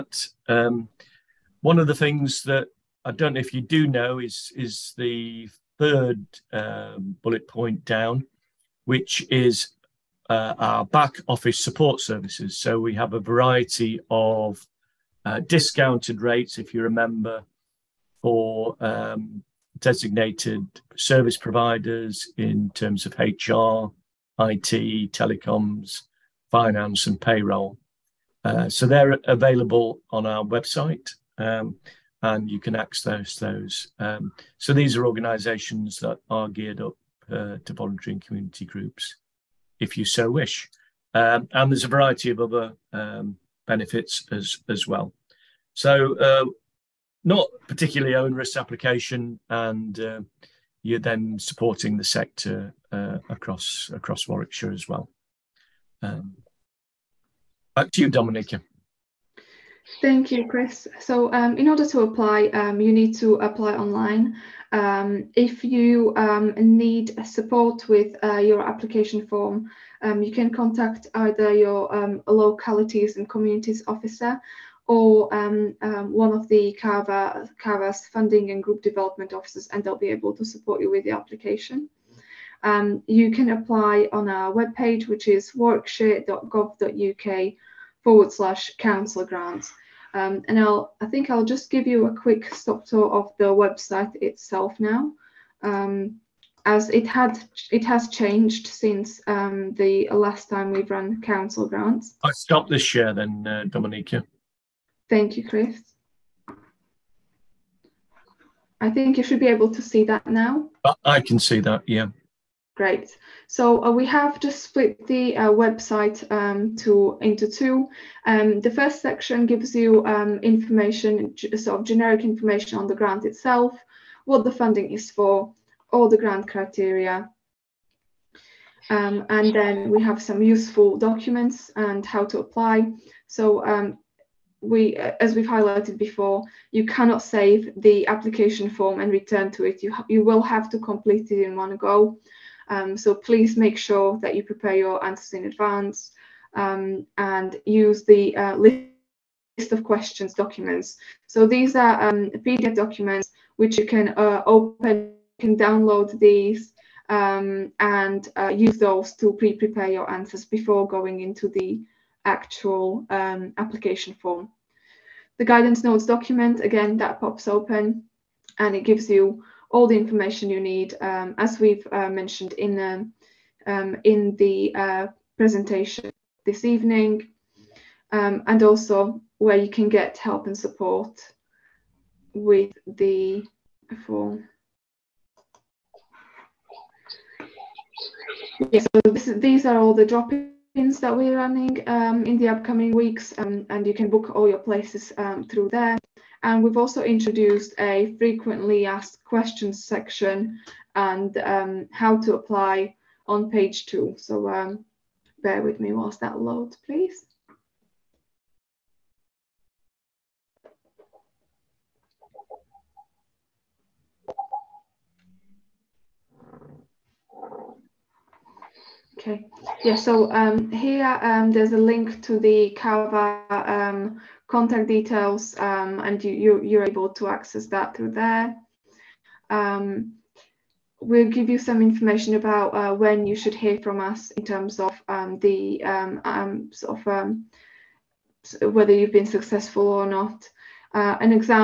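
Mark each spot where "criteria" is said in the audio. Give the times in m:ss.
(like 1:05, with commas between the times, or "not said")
2:06.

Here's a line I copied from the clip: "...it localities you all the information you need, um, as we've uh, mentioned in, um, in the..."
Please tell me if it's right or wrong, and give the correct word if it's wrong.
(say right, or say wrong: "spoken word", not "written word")
wrong: "gives", not "localities".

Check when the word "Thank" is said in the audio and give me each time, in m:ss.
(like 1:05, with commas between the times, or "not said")
1:00, 1:45.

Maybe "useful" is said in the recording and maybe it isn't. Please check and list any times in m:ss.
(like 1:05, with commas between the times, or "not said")
2:10.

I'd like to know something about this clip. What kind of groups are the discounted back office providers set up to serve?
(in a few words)
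volunteering community groups.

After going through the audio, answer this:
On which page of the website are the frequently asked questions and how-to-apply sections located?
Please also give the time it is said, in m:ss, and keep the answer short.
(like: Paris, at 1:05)
page 2, at 3:23.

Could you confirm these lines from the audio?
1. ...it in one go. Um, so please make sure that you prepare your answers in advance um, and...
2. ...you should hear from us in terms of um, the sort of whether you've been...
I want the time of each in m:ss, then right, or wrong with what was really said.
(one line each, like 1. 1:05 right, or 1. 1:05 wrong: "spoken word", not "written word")
1. 2:21 right
2. 3:53 right.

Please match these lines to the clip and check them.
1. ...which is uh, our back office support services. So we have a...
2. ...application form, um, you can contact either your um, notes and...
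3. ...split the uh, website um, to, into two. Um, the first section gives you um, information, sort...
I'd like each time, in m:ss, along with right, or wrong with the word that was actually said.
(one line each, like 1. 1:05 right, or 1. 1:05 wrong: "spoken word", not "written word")
1. 0:08 right
2. 1:08 wrong: "localities", not "notes"
3. 1:54 right.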